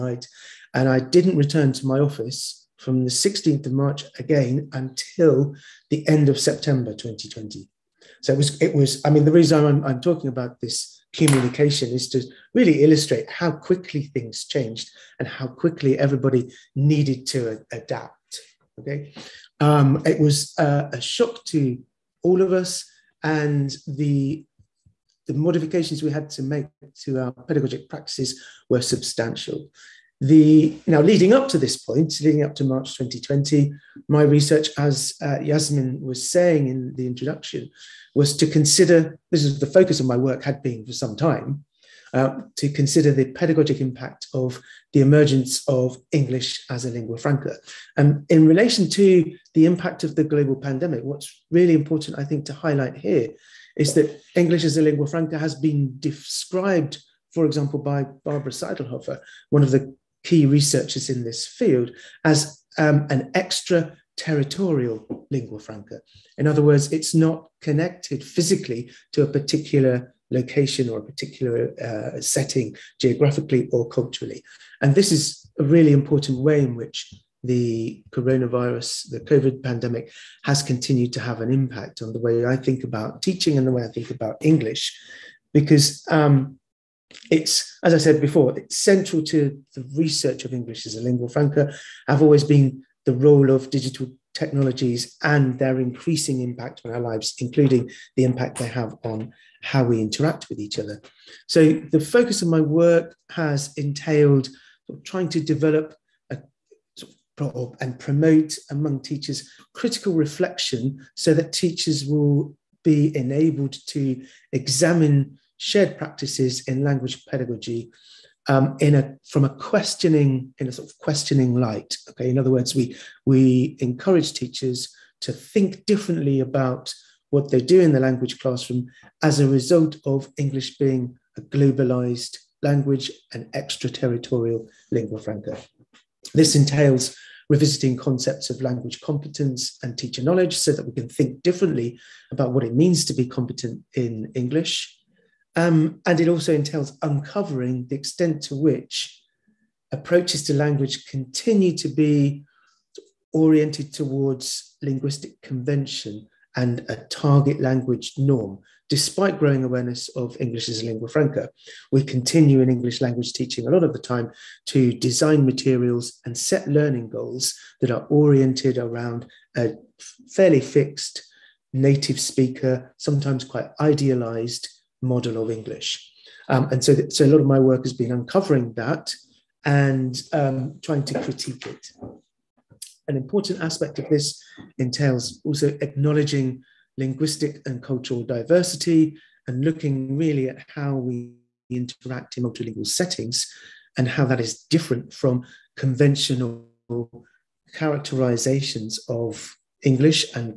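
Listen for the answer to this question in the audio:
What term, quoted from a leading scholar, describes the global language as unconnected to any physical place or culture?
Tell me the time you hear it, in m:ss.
1:03.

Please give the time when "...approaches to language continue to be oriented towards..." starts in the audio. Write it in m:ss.
2:29.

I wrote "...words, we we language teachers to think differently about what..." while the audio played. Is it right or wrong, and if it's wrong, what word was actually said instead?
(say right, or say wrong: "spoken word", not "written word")
wrong: "encourage", not "language".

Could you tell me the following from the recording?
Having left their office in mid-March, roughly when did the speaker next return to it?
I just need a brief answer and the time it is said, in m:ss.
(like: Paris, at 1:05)
end of September 2020, at 0:06.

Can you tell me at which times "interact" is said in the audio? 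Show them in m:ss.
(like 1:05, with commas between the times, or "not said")
1:39, 3:11.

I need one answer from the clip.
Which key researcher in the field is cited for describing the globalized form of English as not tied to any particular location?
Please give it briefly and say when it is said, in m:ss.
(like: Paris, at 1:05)
Barbara Seidlhofer, at 0:58.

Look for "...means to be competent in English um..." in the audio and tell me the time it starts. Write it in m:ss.
2:22.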